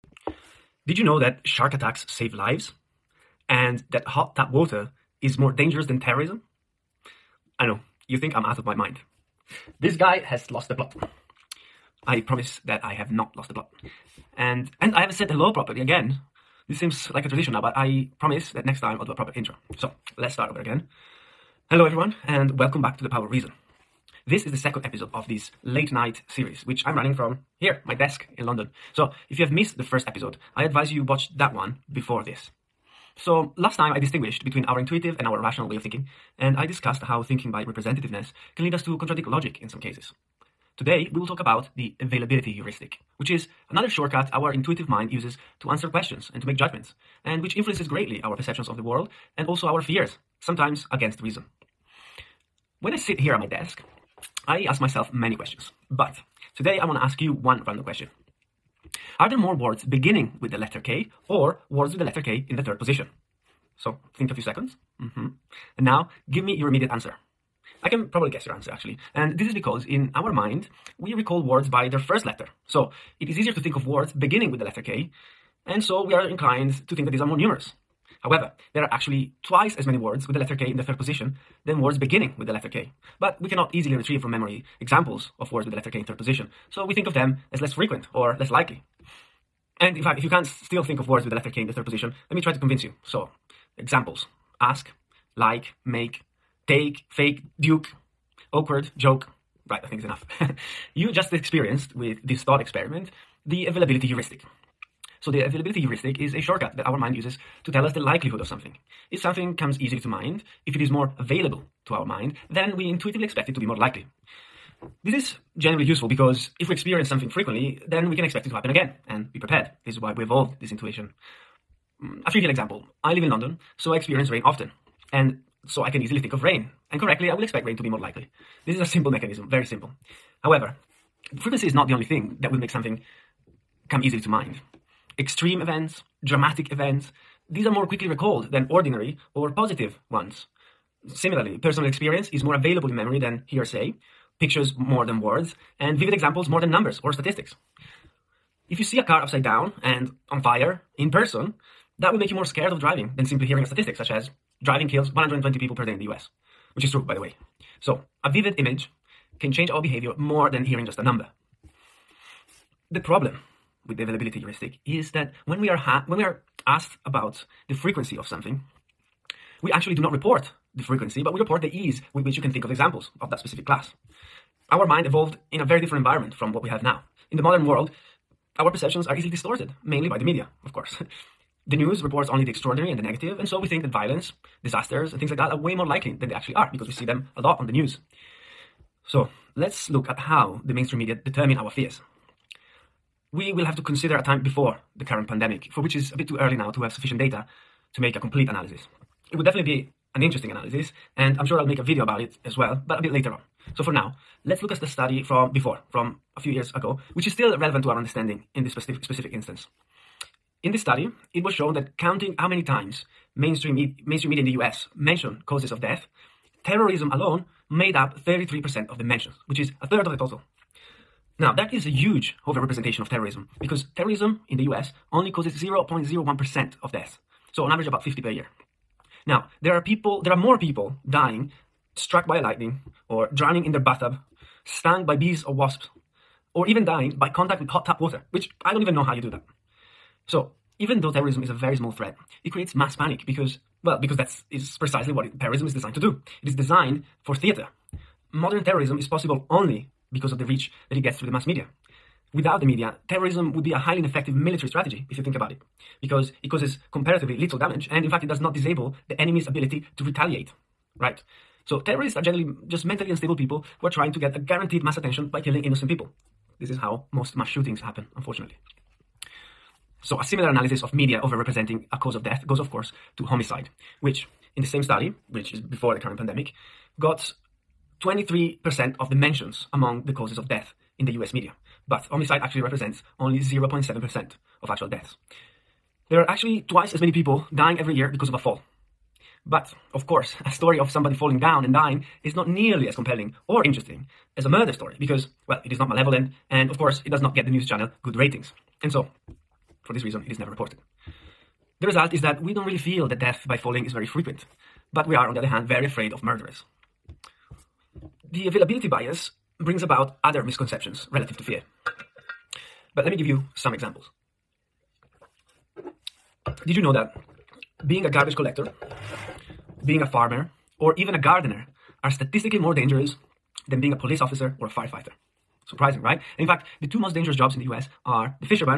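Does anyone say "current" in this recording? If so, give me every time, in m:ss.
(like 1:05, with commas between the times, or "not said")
3:15, 4:35.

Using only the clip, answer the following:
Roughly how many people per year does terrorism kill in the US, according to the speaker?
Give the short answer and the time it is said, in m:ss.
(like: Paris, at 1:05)
50, at 3:48.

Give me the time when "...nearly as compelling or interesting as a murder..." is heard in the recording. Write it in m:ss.
4:52.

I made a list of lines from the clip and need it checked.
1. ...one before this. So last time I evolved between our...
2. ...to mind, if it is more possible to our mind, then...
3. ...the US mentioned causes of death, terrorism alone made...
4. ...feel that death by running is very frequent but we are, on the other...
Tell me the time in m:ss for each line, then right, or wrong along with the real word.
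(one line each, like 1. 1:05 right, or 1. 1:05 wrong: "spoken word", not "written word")
1. 0:31 wrong: "distinguished", not "evolved"
2. 1:49 wrong: "available", not "possible"
3. 3:34 right
4. 5:02 wrong: "falling", not "running".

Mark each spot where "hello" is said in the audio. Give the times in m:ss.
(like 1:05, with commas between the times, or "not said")
0:15, 0:21.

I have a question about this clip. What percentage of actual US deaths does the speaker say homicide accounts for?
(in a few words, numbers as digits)
0.7%.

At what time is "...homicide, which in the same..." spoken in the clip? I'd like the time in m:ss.
4:33.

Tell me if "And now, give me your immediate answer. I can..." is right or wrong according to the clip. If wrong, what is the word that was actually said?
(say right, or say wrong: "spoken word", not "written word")
right.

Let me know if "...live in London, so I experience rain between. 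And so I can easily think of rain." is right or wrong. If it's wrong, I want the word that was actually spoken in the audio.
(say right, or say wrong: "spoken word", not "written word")
wrong: "often", not "between".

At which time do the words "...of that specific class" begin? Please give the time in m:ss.
2:53.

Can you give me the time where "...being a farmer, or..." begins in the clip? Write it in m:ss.
5:19.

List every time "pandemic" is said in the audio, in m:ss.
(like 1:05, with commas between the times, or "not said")
3:15, 4:36.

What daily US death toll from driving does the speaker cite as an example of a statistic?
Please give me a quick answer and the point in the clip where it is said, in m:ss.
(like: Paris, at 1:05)
120 people per day, at 2:35.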